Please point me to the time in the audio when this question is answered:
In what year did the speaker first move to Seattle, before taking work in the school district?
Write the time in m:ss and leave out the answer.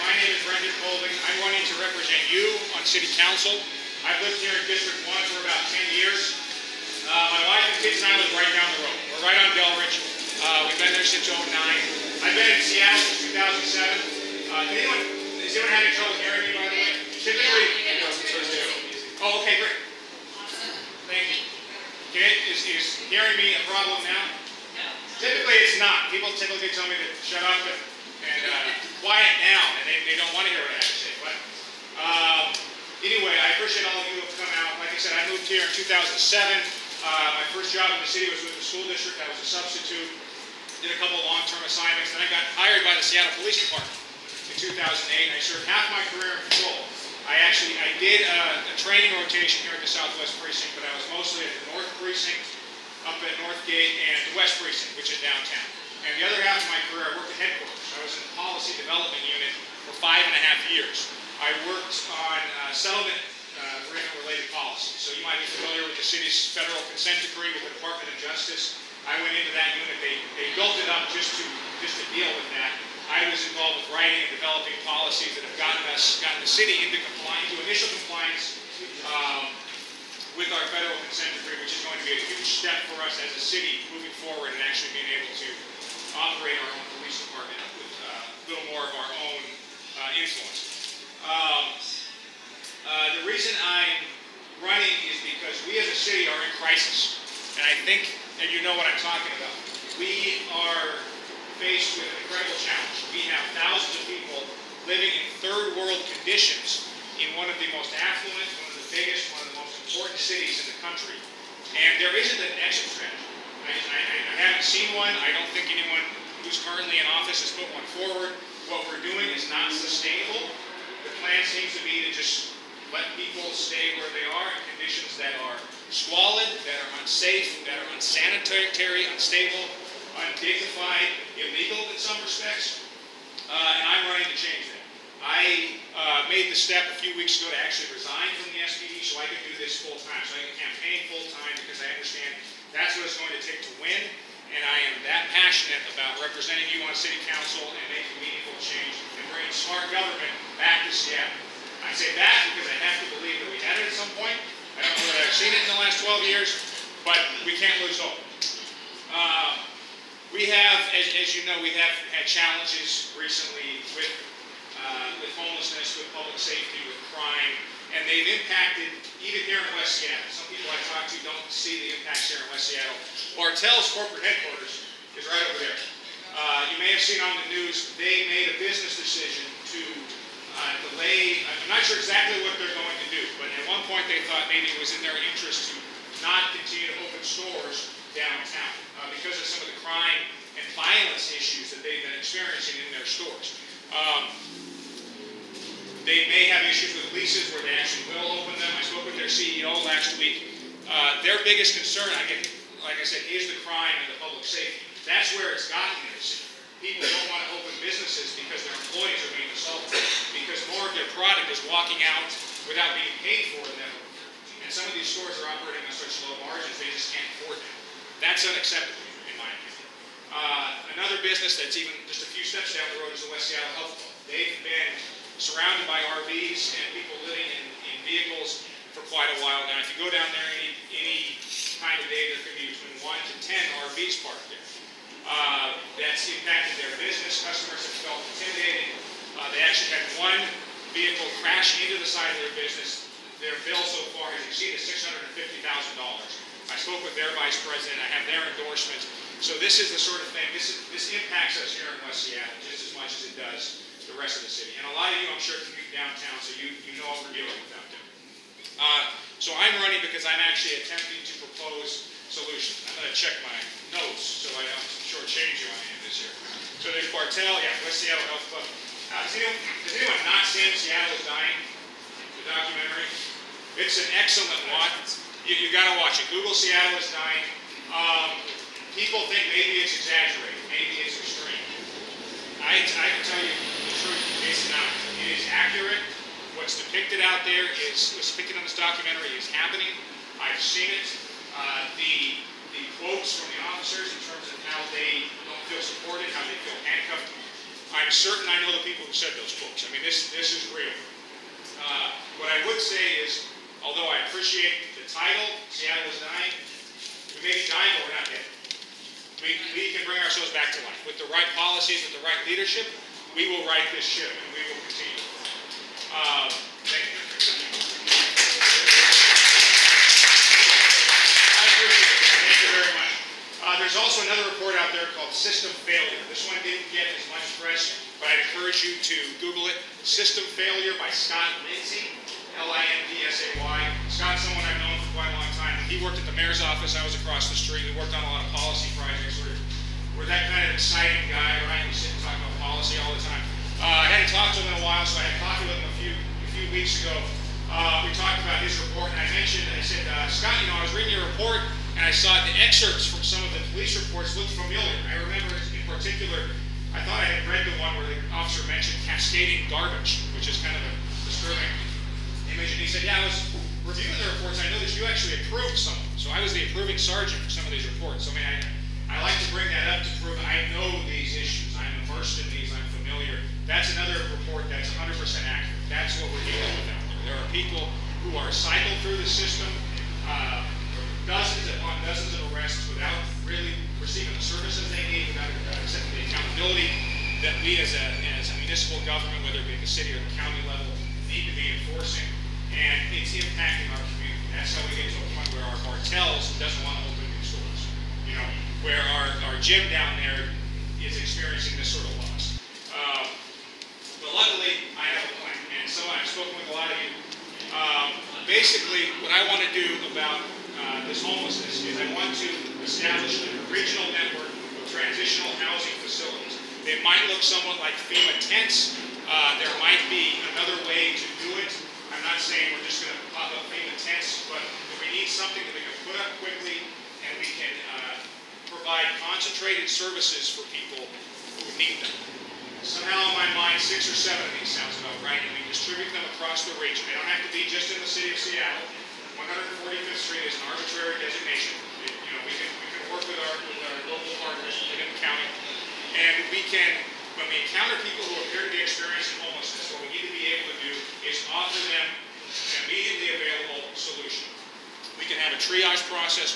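0:11.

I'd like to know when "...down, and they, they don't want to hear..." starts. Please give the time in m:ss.
0:29.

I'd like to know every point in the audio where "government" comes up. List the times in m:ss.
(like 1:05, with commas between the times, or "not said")
2:29, 6:29.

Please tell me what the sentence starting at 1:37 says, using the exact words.
And I think and you know what I'm talking about.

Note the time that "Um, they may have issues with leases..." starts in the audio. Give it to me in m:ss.
3:13.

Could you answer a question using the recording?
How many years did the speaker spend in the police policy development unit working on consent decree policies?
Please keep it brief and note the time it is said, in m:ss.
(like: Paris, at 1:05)
5.5, at 1:00.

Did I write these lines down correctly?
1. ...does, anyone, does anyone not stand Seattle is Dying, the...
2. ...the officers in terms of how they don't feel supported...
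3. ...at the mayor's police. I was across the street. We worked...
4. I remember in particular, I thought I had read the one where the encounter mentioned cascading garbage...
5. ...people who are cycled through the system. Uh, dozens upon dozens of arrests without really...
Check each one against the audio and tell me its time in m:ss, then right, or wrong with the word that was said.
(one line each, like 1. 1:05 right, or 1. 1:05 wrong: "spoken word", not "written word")
1. 4:29 right
2. 4:53 right
3. 5:36 wrong: "office", not "police"
4. 5:55 wrong: "officer", not "encounter"
5. 6:17 right.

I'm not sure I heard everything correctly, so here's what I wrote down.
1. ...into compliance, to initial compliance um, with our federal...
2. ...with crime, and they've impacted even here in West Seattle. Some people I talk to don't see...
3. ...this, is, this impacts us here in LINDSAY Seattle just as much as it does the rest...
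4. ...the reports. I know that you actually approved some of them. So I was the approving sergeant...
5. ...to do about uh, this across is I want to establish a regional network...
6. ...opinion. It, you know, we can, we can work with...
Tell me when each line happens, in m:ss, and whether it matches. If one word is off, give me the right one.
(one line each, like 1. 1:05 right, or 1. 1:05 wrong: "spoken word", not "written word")
1. 1:16 right
2. 2:46 right
3. 4:10 wrong: "West", not "LINDSAY"
4. 6:04 right
5. 6:49 wrong: "homelessness", not "across"
6. 7:21 wrong: "designation", not "opinion".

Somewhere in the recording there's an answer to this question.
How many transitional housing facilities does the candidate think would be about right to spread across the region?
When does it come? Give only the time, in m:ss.
7:13.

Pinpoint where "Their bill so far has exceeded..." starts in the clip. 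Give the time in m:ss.
4:03.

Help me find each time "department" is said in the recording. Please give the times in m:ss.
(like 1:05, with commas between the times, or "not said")
0:43, 1:07, 1:27.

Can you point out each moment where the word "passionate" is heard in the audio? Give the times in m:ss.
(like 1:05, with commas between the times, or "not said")
2:25.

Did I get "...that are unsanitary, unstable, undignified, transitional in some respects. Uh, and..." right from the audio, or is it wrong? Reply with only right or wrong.
wrong.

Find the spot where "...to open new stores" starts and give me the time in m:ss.
6:37.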